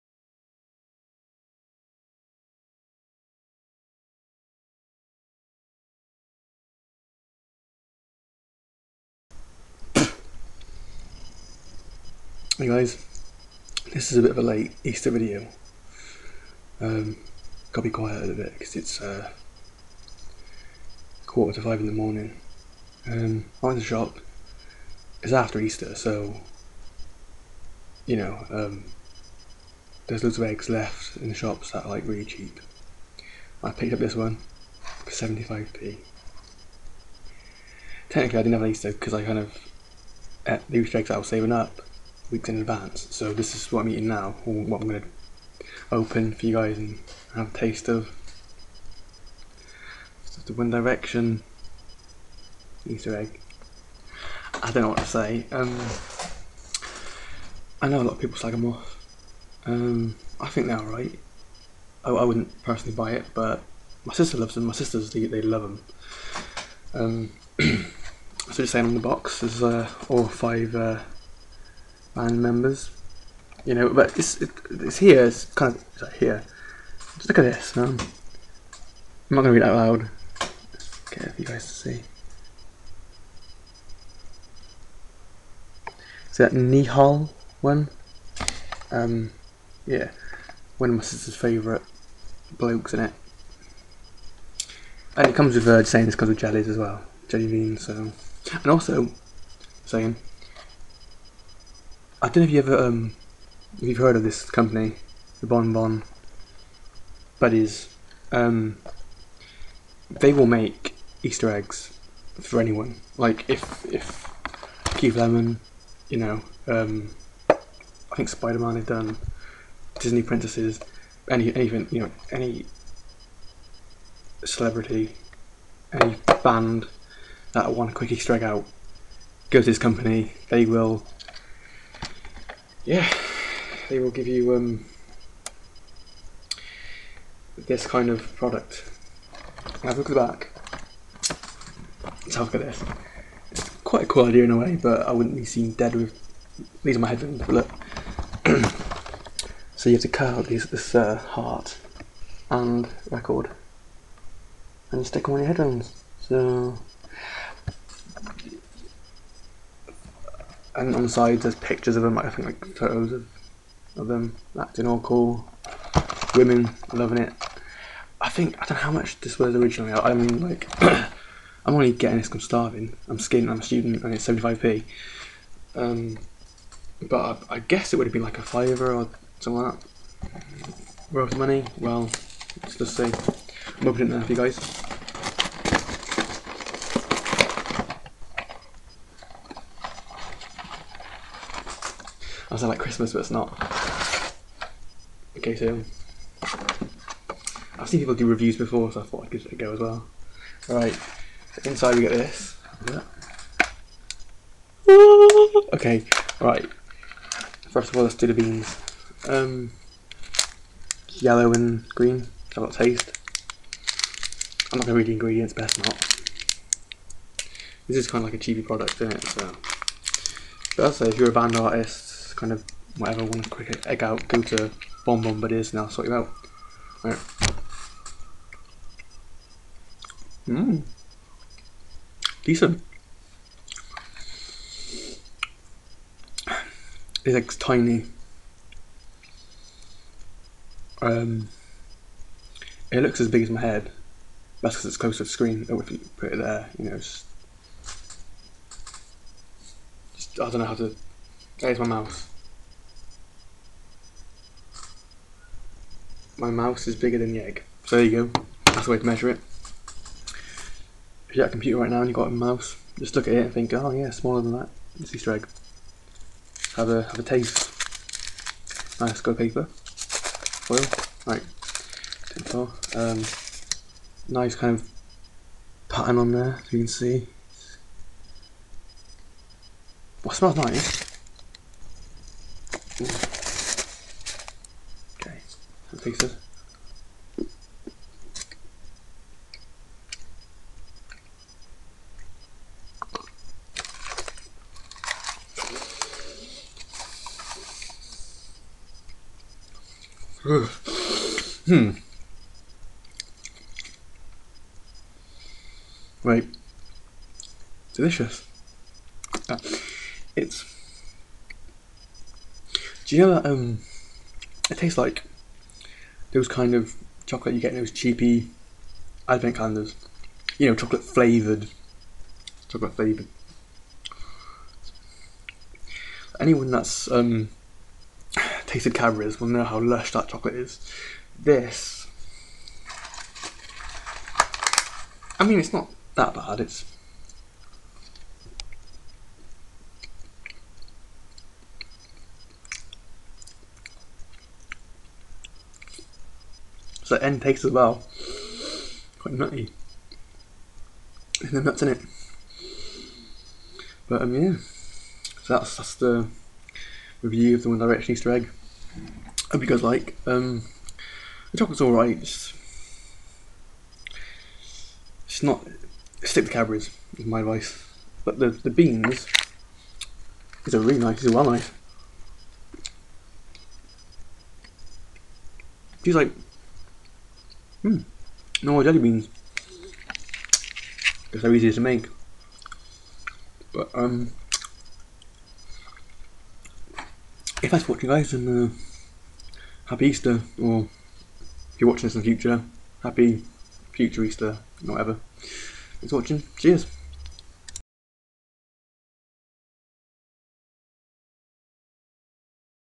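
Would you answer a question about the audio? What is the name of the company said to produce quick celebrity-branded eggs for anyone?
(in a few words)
Bon Bon Buddies.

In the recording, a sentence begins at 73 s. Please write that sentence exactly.
You know, but it's, it, it's here, it's kind of it's like here.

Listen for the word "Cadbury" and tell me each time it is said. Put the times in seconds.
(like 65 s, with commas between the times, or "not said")
328 s, 366 s.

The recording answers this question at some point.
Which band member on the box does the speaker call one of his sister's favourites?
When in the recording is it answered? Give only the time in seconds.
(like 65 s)
86 s.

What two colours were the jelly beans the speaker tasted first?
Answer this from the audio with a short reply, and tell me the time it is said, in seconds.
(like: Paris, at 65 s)
yellow and green, at 211 s.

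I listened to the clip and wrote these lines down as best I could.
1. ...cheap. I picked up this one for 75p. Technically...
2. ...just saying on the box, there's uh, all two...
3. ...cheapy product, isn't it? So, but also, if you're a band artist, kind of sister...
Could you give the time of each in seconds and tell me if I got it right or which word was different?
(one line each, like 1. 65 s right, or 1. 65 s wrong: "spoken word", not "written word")
1. 32 s right
2. 68 s wrong: "five", not "two"
3. 218 s wrong: "whatever", not "sister".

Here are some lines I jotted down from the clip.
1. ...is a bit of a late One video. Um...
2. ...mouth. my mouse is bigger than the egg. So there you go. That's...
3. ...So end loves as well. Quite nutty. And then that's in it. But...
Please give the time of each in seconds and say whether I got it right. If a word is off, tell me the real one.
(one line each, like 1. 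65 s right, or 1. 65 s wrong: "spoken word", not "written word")
1. 14 s wrong: "Easter", not "One"
2. 251 s right
3. 347 s wrong: "takes", not "loves".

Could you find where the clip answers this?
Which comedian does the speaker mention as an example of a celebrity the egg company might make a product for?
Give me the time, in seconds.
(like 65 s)
114 s.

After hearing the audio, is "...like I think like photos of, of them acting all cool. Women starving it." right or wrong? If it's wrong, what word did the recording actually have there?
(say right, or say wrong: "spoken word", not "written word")
wrong: "loving", not "starving".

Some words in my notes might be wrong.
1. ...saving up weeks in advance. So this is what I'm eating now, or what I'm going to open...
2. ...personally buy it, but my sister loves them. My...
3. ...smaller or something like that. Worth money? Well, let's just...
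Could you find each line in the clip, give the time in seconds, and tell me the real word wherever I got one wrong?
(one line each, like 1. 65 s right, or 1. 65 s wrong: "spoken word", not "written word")
1. 41 s right
2. 62 s right
3. 178 s wrong: "fiver", not "smaller".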